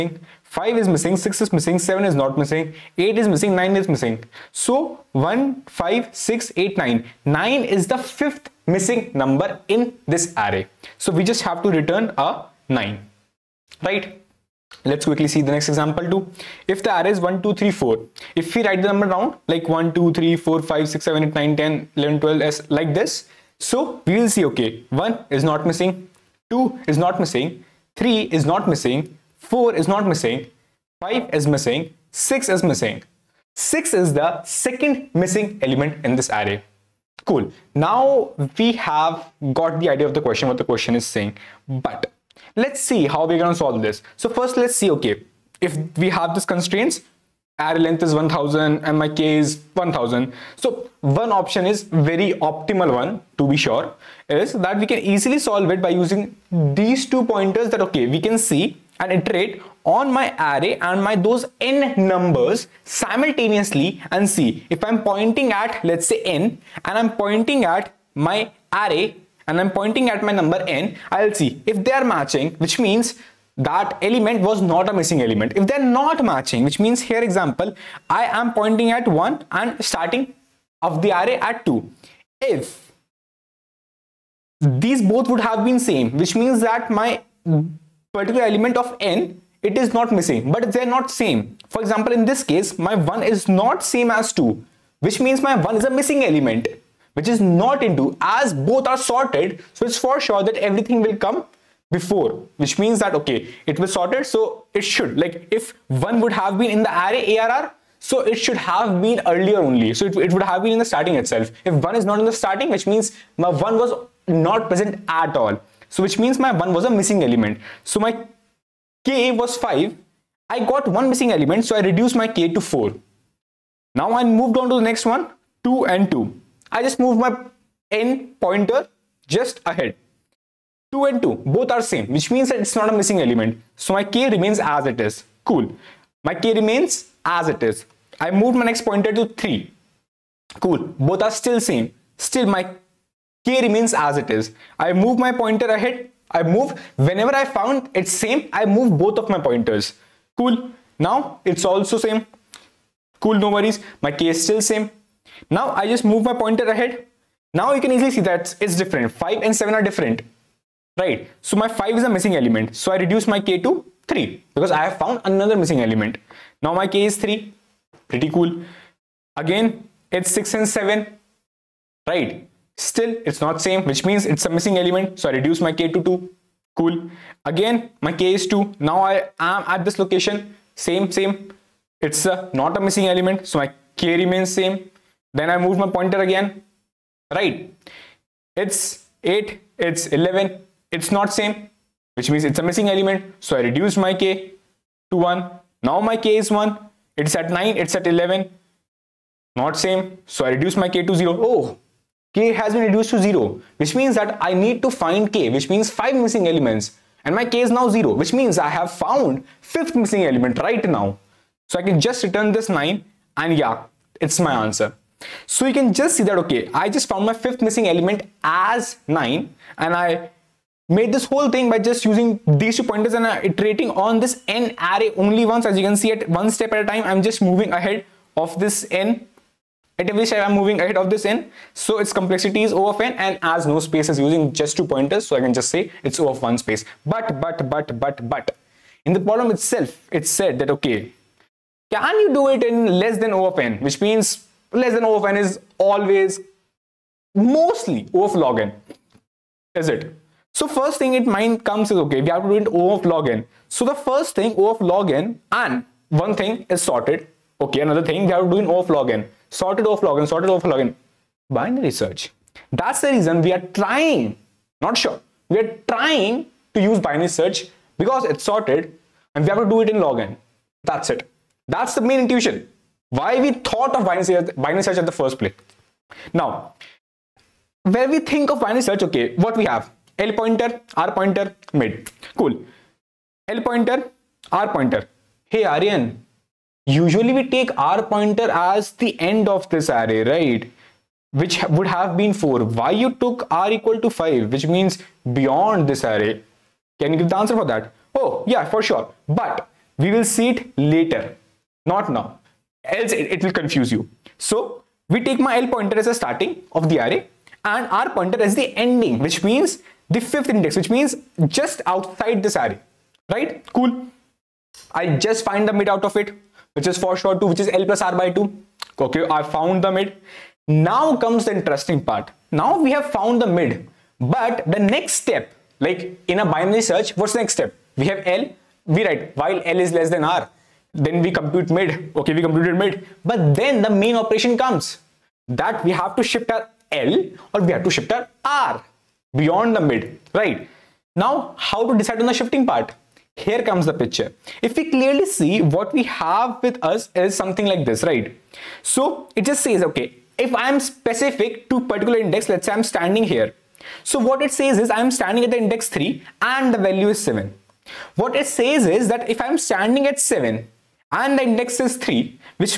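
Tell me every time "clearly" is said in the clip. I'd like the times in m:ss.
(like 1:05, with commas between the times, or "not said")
5:44.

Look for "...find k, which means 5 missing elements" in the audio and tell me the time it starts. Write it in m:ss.
3:24.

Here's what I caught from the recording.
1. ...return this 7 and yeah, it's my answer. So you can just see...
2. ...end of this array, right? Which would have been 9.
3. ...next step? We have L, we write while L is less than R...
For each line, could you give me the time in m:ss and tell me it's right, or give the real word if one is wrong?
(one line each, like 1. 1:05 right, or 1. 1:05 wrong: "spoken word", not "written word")
1. 3:32 wrong: "9", not "7"
2. 4:49 wrong: "4", not "9"
3. 5:27 right.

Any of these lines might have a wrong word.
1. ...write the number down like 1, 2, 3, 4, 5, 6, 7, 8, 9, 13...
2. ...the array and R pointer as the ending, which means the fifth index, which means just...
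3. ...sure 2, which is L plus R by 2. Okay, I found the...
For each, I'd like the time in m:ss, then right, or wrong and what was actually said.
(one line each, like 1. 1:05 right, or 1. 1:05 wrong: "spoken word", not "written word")
1. 0:18 wrong: "10", not "13"
2. 5:06 right
3. 5:17 right.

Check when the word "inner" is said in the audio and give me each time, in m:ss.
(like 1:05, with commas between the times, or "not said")
not said.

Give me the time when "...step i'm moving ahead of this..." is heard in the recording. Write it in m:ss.
3:50.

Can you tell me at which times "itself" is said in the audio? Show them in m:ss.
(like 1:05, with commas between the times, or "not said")
1:51, 3:59.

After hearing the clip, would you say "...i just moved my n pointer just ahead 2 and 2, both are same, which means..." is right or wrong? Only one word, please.
right.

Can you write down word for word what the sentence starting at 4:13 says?
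So the first thing O of log n and one thing is sorted.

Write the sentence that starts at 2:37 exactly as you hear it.
Now you can easily see that it's different.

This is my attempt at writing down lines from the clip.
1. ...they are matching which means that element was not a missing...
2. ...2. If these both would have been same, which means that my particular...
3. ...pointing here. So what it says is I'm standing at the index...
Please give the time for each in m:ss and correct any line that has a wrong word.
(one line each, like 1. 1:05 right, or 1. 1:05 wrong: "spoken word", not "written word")
1. 1:11 right
2. 1:21 right
3. 5:52 wrong: "standing", not "pointing".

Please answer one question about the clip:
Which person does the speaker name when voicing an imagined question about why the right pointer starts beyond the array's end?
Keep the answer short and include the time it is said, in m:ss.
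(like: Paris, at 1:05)
Aryan, at 4:45.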